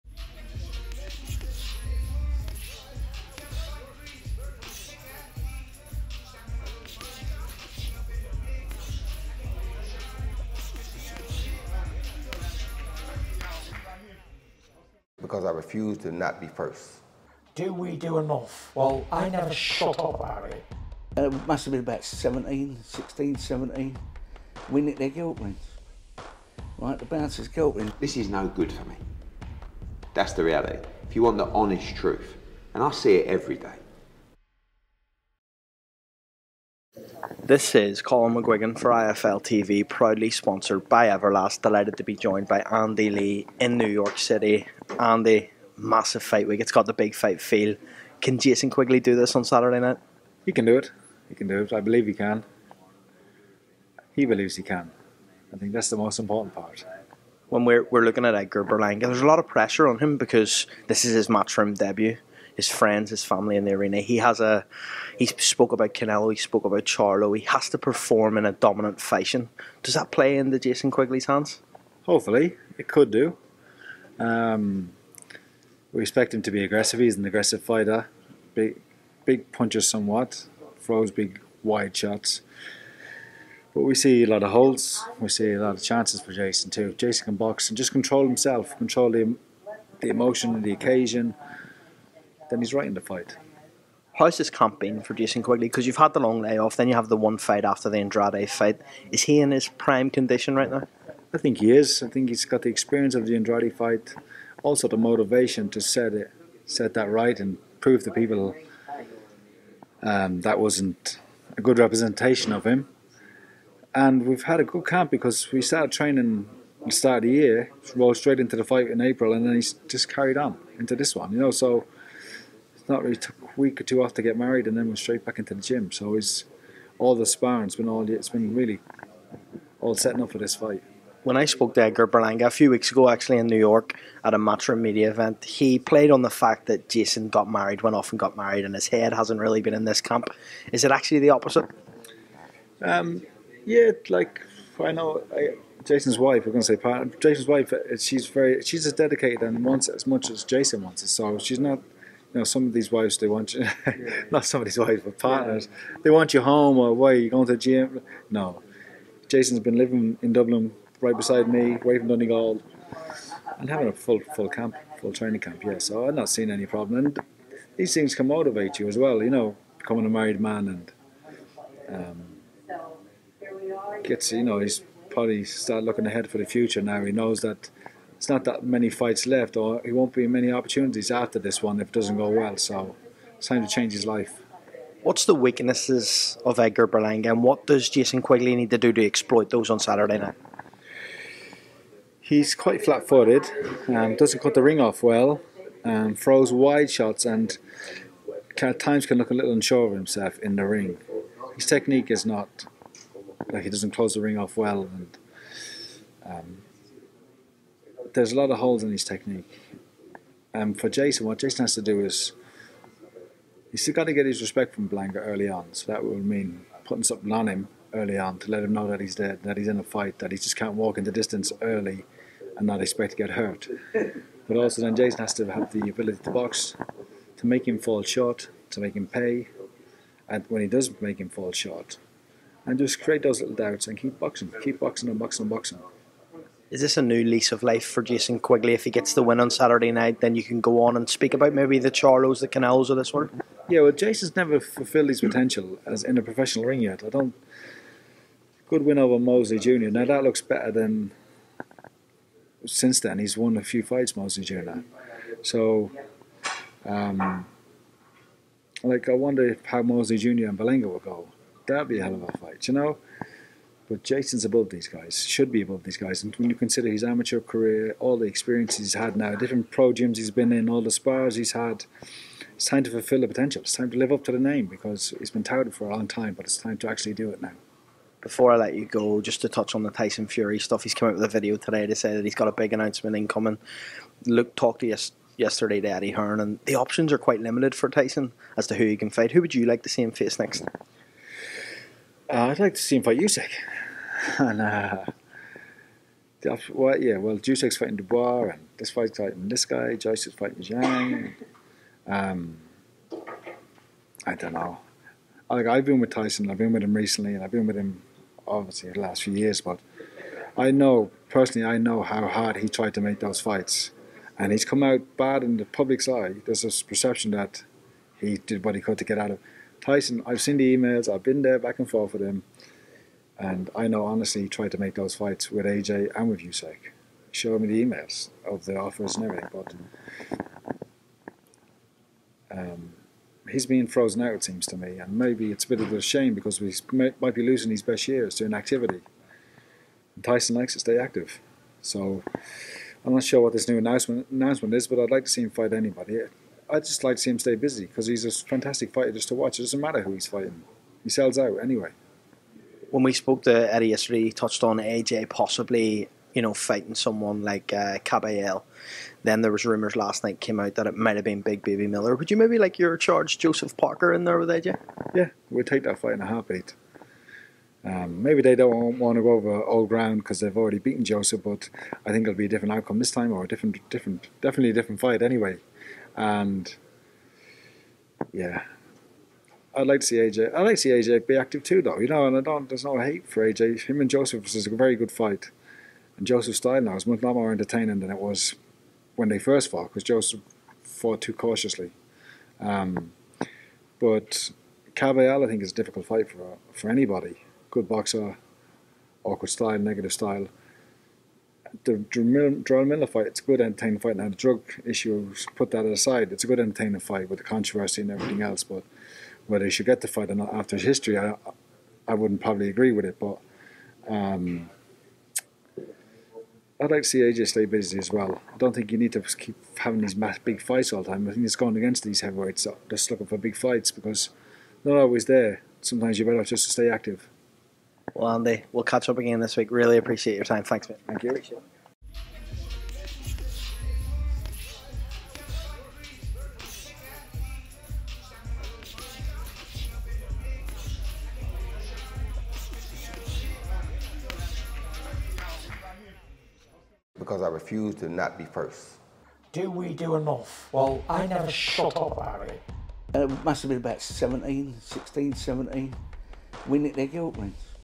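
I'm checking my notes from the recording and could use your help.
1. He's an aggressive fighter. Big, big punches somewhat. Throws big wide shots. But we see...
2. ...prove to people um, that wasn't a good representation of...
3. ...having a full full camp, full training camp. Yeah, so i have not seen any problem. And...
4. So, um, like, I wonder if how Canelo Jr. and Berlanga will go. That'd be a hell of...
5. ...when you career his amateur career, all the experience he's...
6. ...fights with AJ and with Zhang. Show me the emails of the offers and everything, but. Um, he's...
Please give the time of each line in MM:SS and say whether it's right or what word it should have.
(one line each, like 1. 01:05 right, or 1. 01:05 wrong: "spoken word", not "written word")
1. 01:16 right
2. 01:47 right
3. 02:43 right
4. 04:15 wrong: "Mosley", not "Canelo"
5. 04:26 wrong: "consider", not "career"
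6. 05:25 wrong: "Usyk", not "Zhang".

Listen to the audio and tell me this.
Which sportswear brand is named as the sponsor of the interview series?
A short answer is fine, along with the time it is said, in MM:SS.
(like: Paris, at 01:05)
Everlast, at 00:41.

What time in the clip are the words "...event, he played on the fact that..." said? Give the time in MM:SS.
02:15.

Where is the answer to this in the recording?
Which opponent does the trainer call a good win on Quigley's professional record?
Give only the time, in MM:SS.
04:09.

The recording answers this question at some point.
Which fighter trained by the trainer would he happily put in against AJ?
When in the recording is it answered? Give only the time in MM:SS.
06:03.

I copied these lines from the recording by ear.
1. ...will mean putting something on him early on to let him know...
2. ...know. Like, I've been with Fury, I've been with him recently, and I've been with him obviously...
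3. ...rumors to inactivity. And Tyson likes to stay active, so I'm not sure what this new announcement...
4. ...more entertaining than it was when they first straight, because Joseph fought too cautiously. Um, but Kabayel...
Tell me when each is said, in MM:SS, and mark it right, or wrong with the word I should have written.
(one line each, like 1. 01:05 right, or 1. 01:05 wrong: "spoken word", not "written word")
1. 03:36 right
2. 05:04 wrong: "Tyson", not "Fury"
3. 05:38 wrong: "years", not "rumors"
4. 06:27 wrong: "fought", not "straight".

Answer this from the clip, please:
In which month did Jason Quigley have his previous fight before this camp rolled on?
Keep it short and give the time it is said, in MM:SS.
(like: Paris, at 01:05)
April, at 01:58.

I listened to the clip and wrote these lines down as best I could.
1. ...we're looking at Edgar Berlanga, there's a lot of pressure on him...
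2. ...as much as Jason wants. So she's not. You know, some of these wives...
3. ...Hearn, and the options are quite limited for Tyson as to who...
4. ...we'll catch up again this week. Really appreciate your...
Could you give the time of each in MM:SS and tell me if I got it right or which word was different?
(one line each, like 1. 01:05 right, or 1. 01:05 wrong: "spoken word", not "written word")
1. 00:57 right
2. 02:29 right
3. 04:46 right
4. 07:08 right.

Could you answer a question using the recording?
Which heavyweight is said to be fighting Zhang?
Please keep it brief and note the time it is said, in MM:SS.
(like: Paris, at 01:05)
Joyce, at 04:59.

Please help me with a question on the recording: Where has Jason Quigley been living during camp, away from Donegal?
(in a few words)
Dublin.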